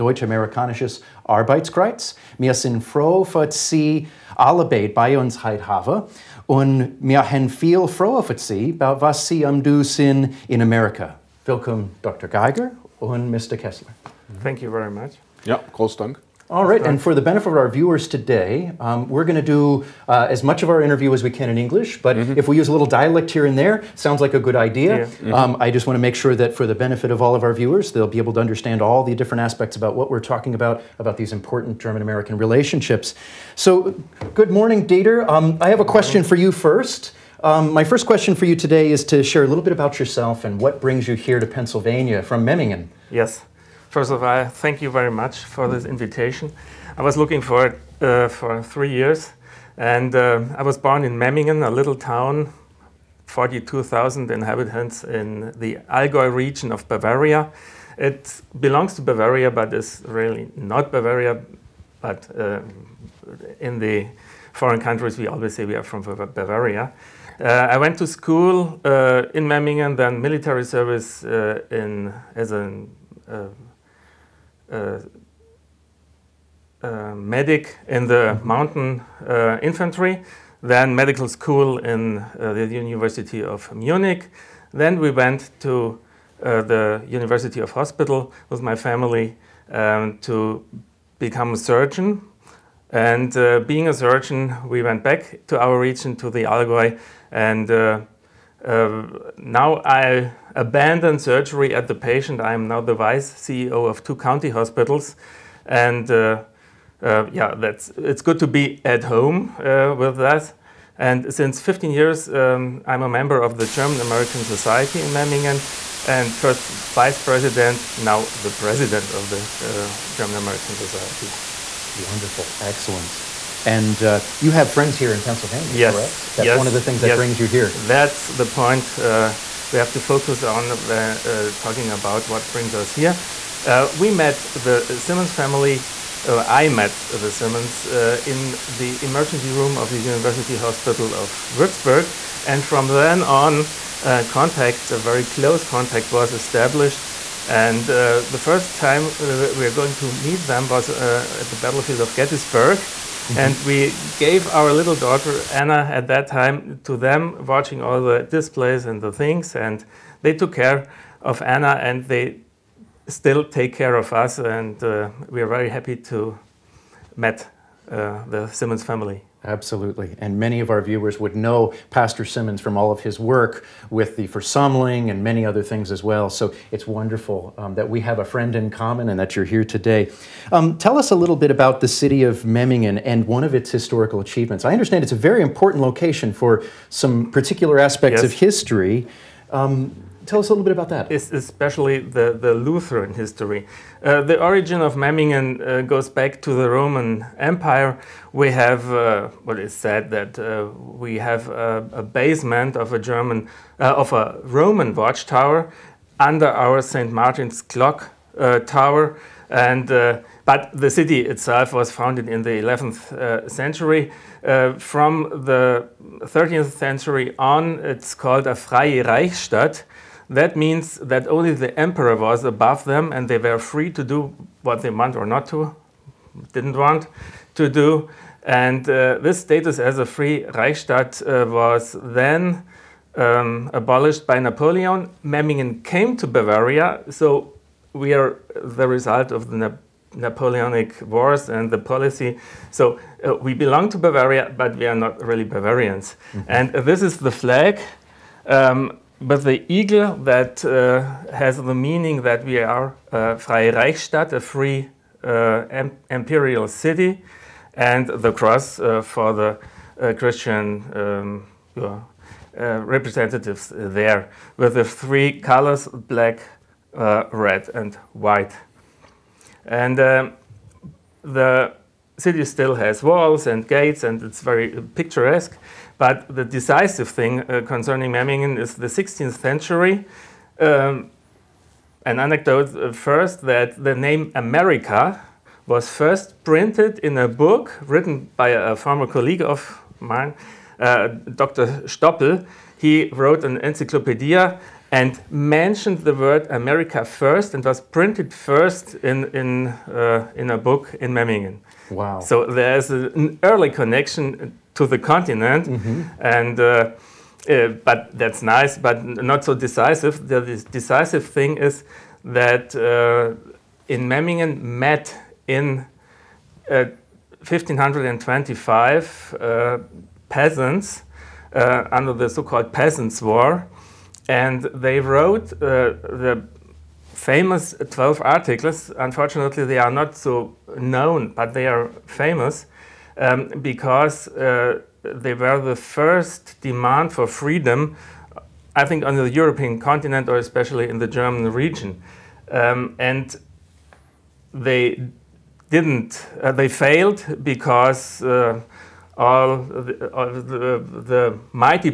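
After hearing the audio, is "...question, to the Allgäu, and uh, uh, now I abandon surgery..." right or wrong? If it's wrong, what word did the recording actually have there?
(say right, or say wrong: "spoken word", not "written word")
wrong: "region", not "question".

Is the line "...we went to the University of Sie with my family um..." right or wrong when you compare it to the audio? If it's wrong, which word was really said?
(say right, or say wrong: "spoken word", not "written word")
wrong: "Hospital", not "Sie".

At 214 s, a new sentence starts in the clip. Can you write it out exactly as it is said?
Uh, from the 13th century on, it's called a Freie Reichsstadt.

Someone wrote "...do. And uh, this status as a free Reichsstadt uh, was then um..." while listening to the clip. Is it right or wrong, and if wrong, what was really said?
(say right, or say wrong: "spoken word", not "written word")
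right.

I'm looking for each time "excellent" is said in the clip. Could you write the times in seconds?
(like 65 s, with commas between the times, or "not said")
122 s.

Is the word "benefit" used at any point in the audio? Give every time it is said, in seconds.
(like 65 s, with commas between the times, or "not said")
17 s, 26 s.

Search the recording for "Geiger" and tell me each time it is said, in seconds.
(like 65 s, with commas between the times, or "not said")
12 s.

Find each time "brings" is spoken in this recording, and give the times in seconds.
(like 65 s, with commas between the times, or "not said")
40 s, 127 s, 132 s.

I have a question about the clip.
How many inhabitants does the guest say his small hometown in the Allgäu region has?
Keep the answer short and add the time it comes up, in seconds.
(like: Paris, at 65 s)
42,000, at 53 s.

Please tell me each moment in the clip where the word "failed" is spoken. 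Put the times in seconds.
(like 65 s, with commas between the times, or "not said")
346 s.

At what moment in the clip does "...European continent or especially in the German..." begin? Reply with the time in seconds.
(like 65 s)
339 s.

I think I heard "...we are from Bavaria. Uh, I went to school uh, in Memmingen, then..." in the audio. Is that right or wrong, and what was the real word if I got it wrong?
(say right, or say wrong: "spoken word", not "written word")
right.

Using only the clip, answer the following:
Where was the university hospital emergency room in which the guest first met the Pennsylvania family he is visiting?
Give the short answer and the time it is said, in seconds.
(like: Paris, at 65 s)
Würzburg, at 139 s.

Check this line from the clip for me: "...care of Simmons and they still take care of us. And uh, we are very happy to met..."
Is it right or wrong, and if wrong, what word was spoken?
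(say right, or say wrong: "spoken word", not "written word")
wrong: "Anna", not "Simmons".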